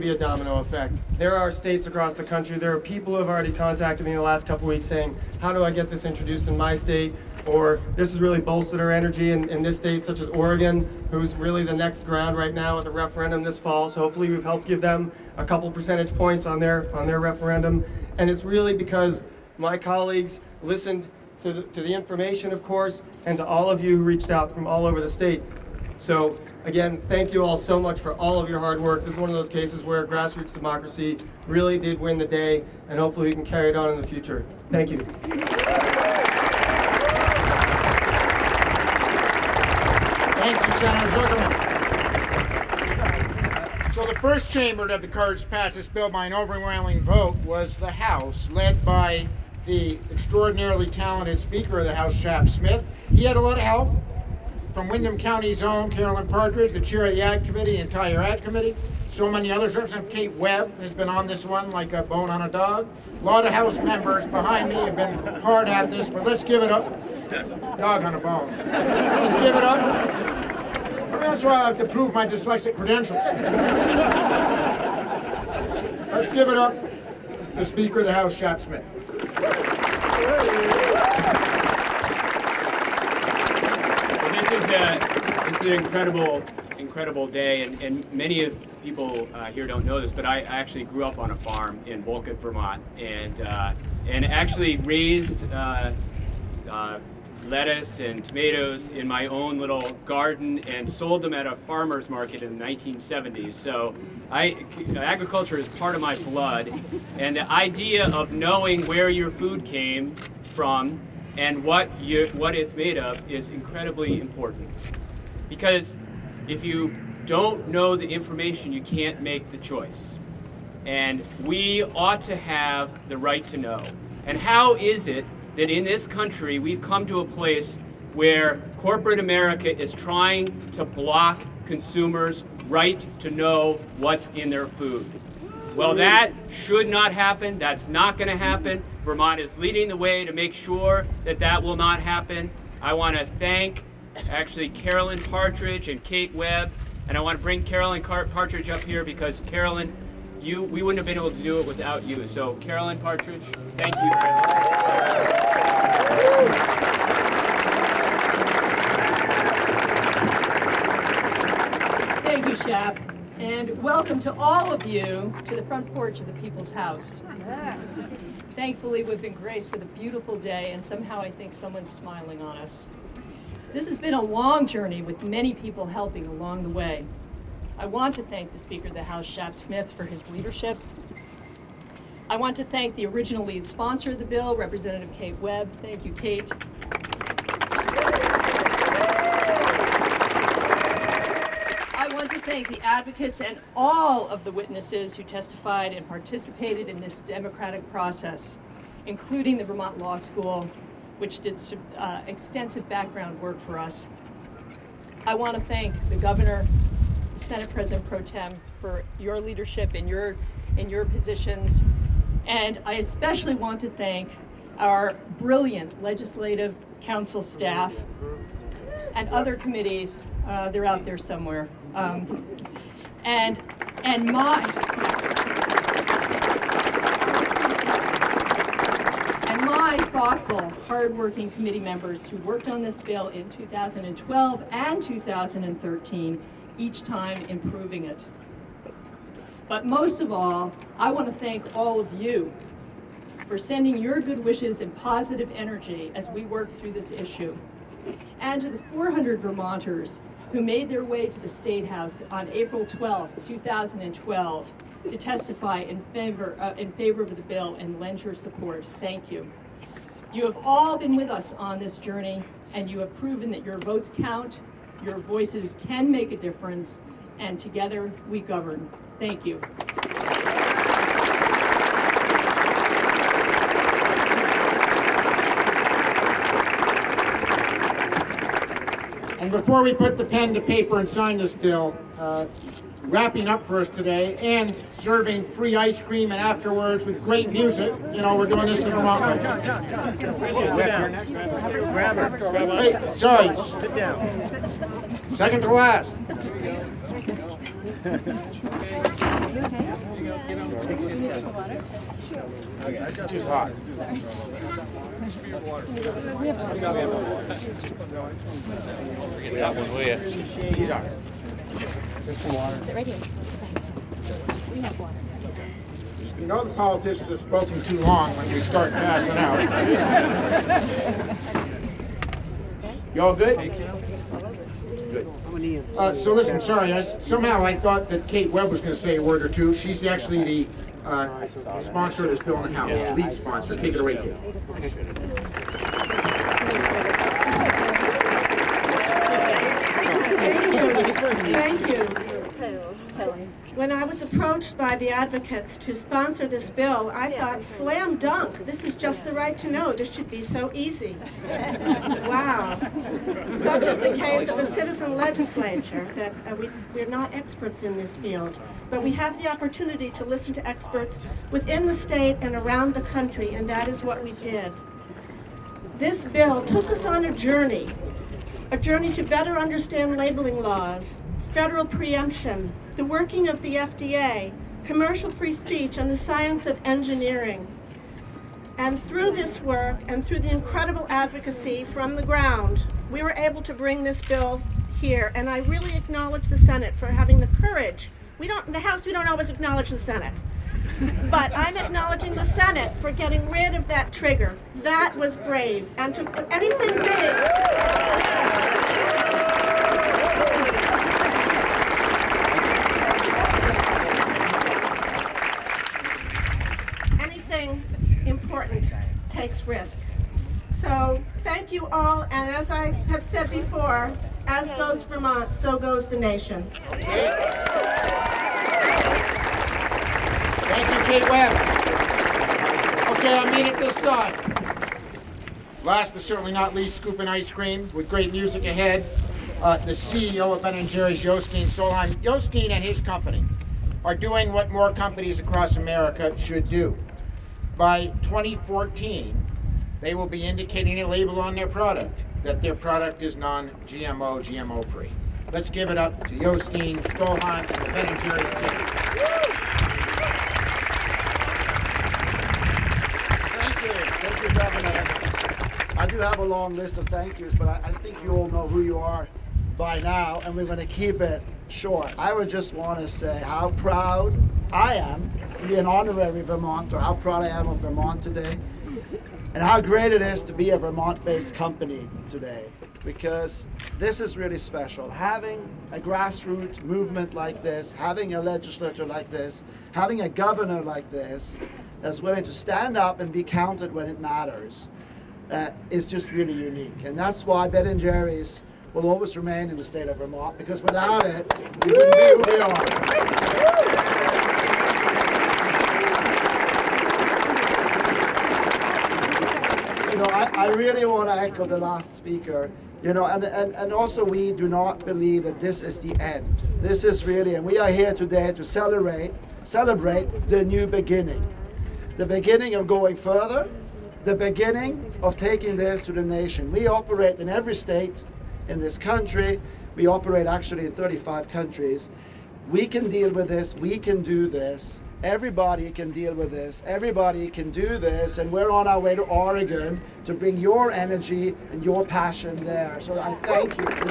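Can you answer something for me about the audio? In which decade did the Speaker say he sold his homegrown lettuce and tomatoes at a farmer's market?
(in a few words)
1970s.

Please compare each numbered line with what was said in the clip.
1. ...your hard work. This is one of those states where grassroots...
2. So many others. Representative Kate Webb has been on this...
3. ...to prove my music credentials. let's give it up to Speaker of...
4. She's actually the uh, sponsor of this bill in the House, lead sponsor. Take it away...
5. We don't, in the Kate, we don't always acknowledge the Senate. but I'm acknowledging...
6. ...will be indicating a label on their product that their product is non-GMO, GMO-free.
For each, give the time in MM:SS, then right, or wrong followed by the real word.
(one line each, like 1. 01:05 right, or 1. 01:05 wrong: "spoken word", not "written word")
1. 00:28 wrong: "cases", not "states"
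2. 00:59 right
3. 01:11 wrong: "dyslexic", not "music"
4. 05:29 right
5. 06:28 wrong: "House", not "Kate"
6. 07:20 right.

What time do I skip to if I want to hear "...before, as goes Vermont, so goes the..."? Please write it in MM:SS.
06:53.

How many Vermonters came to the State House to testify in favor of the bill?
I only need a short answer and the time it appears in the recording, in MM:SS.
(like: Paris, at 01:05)
400, at 04:08.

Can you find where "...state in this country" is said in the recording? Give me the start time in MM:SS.
08:37.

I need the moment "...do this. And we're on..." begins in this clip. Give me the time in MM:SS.
08:47.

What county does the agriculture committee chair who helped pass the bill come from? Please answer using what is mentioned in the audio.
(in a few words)
Windham County.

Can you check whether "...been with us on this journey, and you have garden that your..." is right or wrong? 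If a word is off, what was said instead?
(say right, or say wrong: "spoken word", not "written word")
wrong: "proven", not "garden".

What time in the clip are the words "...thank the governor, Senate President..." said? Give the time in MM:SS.
03:25.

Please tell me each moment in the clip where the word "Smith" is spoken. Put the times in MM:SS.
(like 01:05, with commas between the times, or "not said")
00:52, 01:18, 02:59.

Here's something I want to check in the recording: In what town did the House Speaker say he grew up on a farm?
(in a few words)
Vulcan, Vermont.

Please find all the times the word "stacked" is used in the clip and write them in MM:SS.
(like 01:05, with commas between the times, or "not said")
not said.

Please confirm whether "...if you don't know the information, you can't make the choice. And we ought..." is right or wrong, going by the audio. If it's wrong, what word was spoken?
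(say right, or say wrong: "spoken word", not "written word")
right.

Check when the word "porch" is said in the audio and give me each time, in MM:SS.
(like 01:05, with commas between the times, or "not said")
02:45.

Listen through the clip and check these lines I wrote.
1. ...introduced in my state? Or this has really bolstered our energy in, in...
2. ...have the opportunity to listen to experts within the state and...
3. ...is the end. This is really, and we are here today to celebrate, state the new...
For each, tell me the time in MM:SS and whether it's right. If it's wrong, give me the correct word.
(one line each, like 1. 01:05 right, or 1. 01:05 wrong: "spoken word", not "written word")
1. 00:06 right
2. 05:59 right
3. 08:25 wrong: "celebrate", not "state".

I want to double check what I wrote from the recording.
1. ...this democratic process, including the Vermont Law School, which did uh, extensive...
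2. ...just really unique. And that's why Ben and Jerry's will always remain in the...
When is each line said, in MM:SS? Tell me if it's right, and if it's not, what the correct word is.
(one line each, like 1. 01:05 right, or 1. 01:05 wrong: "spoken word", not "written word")
1. 03:16 right
2. 08:06 right.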